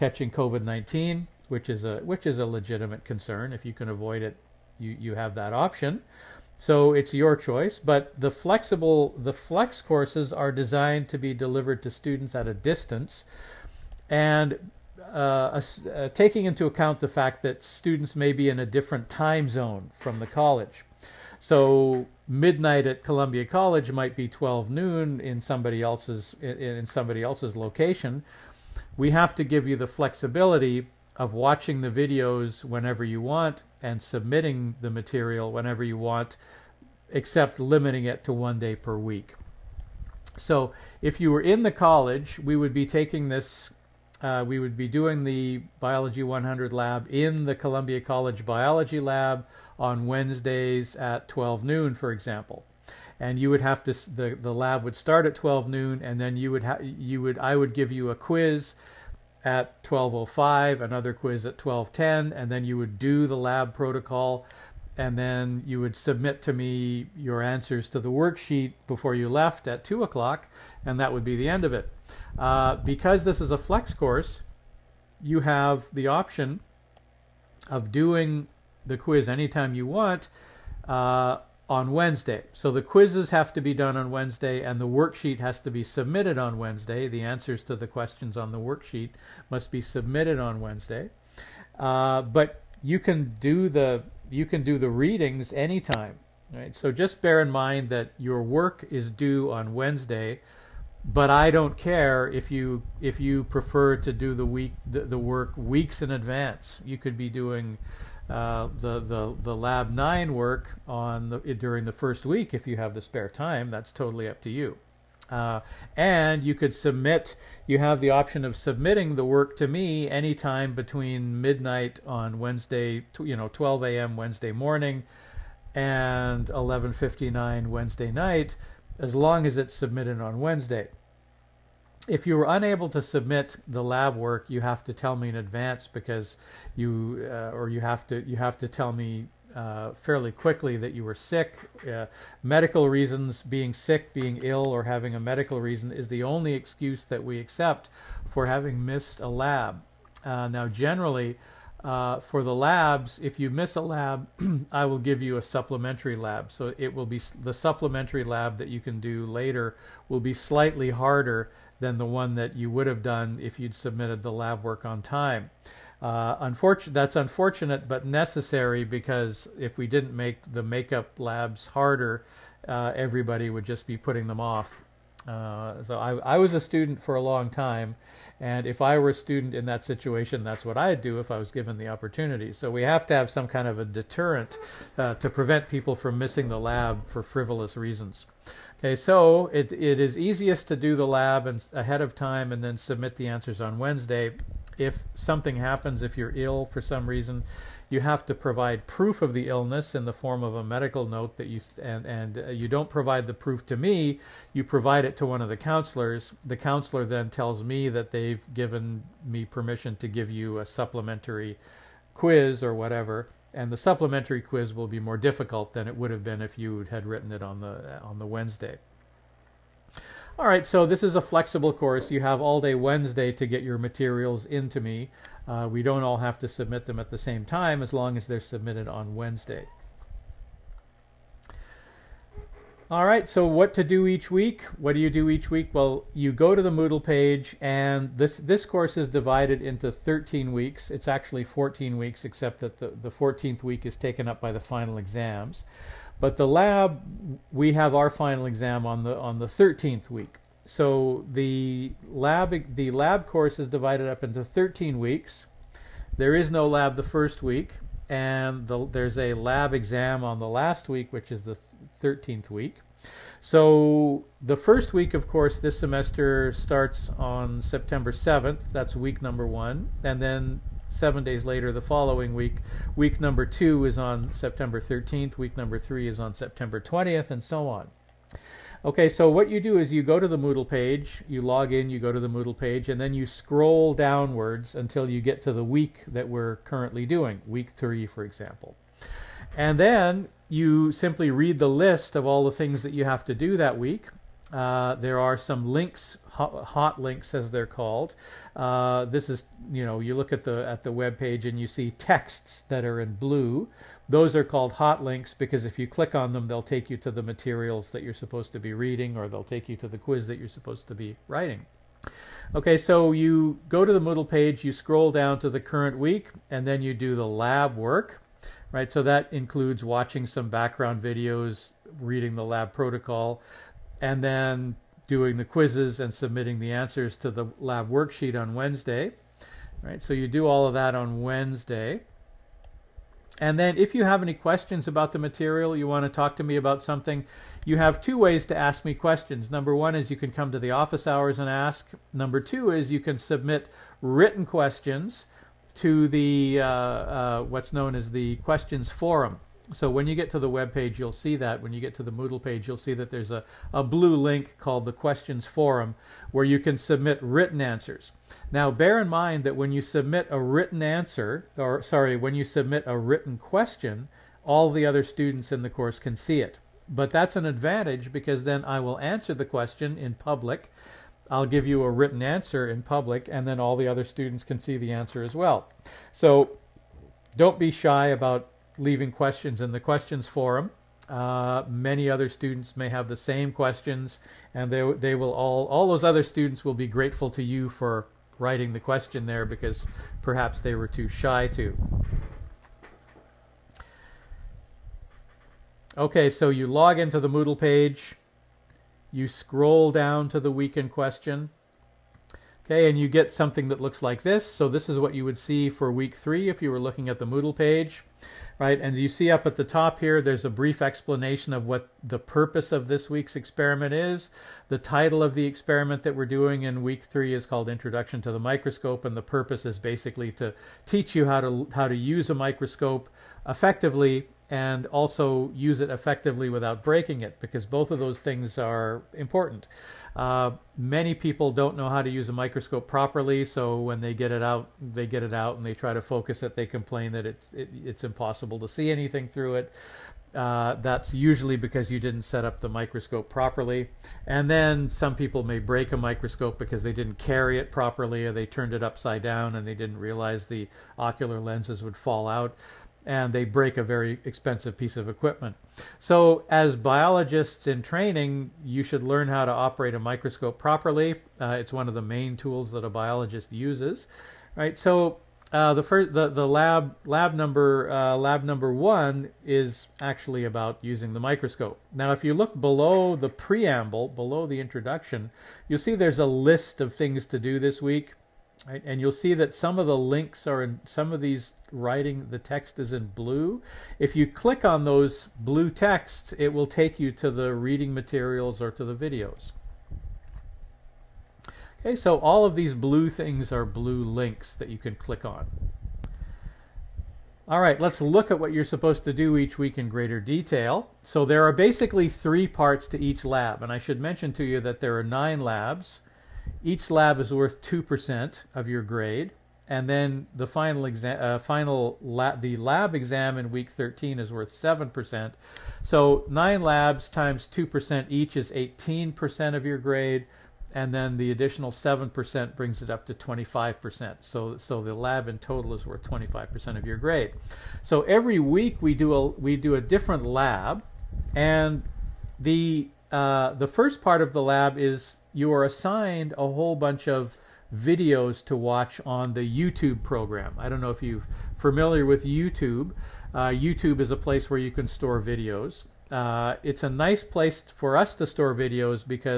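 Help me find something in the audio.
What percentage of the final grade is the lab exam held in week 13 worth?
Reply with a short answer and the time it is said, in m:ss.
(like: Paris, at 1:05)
7%, at 8:34.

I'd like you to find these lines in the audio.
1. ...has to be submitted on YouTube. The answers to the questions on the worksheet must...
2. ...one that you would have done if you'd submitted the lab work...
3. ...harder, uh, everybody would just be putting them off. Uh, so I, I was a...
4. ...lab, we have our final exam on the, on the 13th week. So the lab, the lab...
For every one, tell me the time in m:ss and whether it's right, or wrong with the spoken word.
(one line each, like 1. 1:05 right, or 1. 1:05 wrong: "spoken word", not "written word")
1. 1:25 wrong: "Wednesday", not "YouTube"
2. 2:42 right
3. 2:51 right
4. 4:06 right.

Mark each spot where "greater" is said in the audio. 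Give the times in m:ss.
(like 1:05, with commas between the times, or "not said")
8:19.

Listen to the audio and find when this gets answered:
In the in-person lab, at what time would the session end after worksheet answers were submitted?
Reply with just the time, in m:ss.
1:09.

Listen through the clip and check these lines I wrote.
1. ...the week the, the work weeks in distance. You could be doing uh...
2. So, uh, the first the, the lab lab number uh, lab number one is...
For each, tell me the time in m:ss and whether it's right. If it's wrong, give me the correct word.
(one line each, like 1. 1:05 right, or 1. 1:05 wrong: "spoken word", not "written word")
1. 1:44 wrong: "advance", not "distance"
2. 7:44 right.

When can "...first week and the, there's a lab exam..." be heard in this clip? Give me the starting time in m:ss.
4:17.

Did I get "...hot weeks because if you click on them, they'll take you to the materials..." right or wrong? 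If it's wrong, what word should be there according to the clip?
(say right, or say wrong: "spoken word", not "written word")
wrong: "links", not "weeks".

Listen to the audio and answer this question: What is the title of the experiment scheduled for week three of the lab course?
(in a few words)
Introduction to the Microscope.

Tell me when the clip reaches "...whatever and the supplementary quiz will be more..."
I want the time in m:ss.
3:32.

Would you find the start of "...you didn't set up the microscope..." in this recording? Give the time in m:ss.
7:21.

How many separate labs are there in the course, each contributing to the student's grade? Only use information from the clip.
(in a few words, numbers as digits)
9.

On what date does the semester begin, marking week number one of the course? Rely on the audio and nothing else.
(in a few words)
September 7th.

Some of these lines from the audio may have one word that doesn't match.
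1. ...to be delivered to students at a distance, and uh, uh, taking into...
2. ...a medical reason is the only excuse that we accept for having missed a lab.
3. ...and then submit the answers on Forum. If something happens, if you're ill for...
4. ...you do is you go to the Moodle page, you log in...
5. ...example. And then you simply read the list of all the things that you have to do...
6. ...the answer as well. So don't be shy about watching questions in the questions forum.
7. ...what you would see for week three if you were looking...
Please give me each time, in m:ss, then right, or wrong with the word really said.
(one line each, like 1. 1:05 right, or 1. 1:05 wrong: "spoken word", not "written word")
1. 0:11 right
2. 2:25 right
3. 3:12 wrong: "Wednesday", not "Forum"
4. 4:39 right
5. 4:48 right
6. 6:14 wrong: "leaving", not "watching"
7. 6:44 right.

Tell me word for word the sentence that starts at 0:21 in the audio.
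So midnight at Columbia College might be 12 noon in somebody else's in somebody else's location.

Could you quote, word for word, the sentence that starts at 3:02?
So we have to have some kind of a deterrent uh, to prevent people from missing the lab for frivolous reasons.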